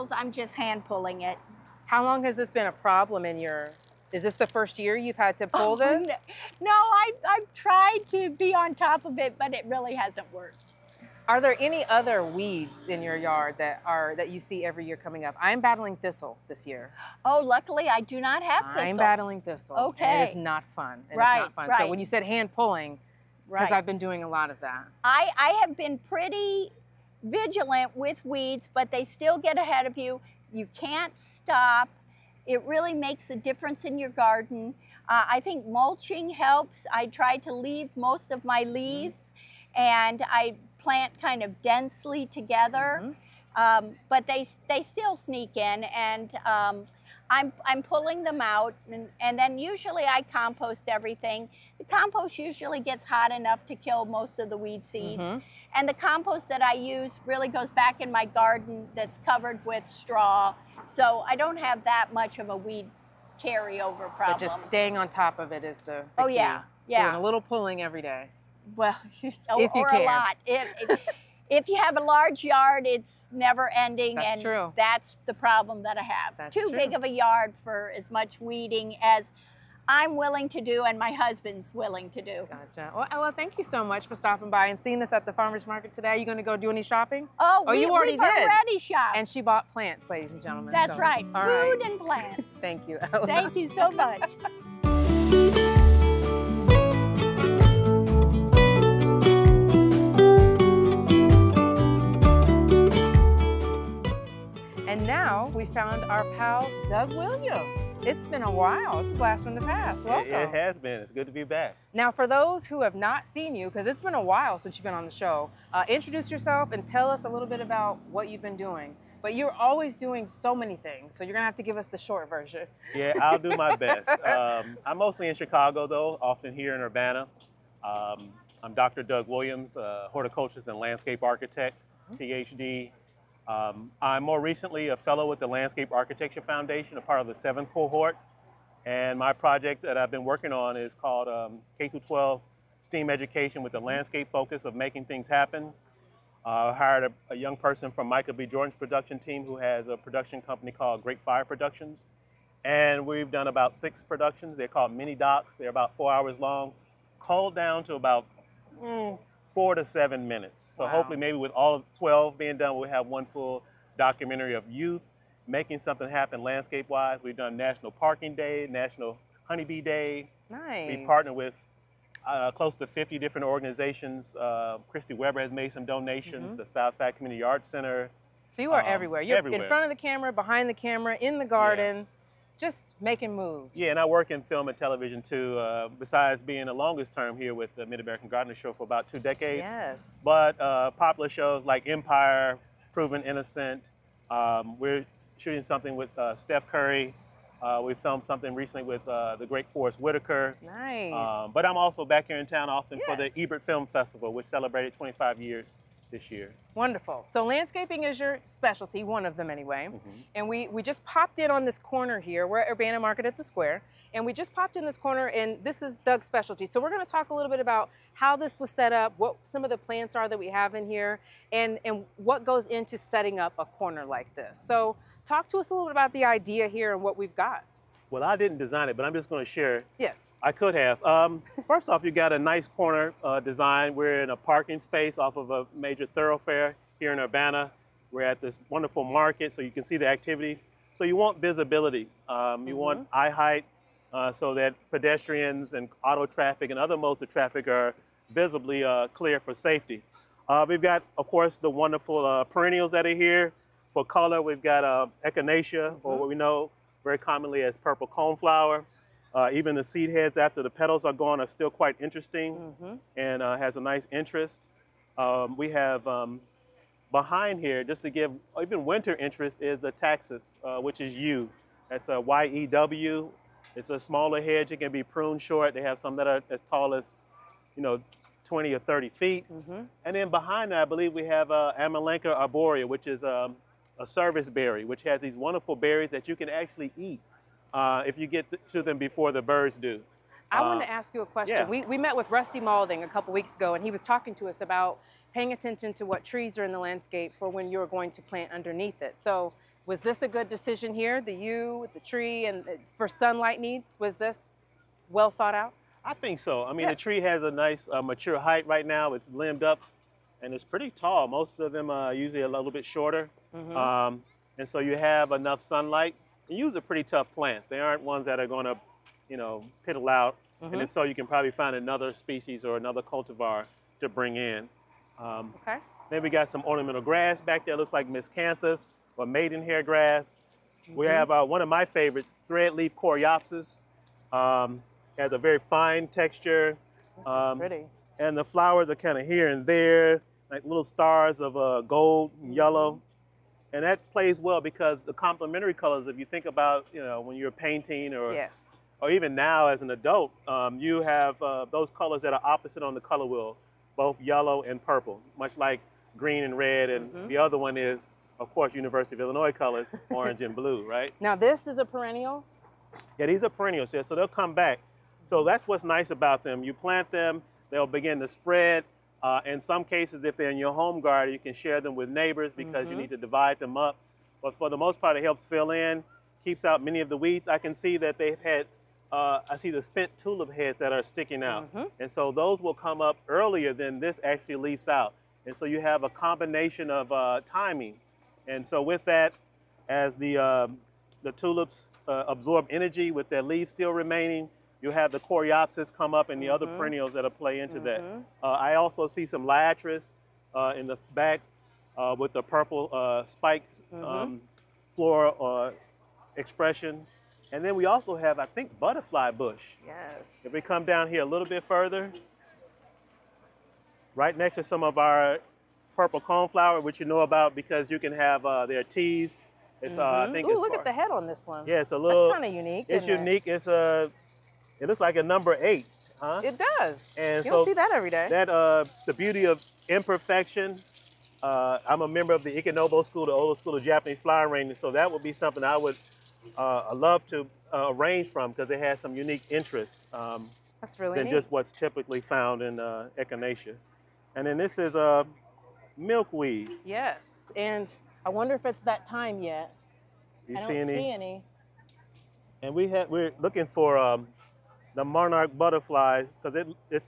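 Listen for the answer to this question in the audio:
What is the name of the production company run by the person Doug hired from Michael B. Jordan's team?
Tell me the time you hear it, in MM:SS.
02:31.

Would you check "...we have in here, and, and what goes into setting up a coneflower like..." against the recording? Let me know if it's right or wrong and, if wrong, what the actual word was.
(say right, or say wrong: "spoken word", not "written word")
wrong: "corner", not "coneflower".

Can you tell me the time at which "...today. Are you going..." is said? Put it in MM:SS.
01:25.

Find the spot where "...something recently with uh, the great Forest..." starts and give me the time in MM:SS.
03:18.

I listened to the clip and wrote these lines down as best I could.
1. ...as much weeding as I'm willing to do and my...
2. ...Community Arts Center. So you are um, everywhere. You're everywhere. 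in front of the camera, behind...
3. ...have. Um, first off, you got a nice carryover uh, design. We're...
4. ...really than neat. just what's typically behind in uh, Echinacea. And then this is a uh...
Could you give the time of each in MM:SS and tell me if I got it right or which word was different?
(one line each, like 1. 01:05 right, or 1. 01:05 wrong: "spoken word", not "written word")
1. 01:17 right
2. 02:57 right
3. 03:50 wrong: "corner", not "carryover"
4. 07:20 wrong: "found", not "behind".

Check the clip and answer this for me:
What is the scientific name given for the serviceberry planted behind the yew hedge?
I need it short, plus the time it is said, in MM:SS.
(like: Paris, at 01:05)
Amelanchier arborea, at 04:41.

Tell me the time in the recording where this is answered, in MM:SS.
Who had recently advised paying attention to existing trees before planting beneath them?
04:52.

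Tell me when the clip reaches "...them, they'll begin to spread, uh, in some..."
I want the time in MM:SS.
06:07.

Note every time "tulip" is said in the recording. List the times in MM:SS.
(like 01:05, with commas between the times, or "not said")
06:20, 06:31.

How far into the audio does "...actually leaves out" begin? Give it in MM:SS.
06:24.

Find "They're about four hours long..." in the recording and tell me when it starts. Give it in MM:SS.
02:35.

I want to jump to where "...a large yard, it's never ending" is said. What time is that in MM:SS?
01:11.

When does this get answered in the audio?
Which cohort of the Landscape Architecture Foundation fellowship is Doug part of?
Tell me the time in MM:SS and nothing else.
02:17.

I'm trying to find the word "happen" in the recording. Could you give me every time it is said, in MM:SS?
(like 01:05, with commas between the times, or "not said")
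02:25, 02:46.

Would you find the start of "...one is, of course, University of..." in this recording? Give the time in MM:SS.
05:57.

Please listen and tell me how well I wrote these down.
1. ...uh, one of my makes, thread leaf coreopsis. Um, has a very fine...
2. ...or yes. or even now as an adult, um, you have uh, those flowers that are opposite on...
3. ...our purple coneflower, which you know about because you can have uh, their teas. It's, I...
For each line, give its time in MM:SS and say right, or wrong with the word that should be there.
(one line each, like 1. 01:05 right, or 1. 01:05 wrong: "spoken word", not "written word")
1. 05:31 wrong: "favorites", not "makes"
2. 05:48 wrong: "colors", not "flowers"
3. 06:54 right.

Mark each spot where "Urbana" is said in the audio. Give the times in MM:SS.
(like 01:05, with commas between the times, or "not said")
02:06, 03:32, 03:57.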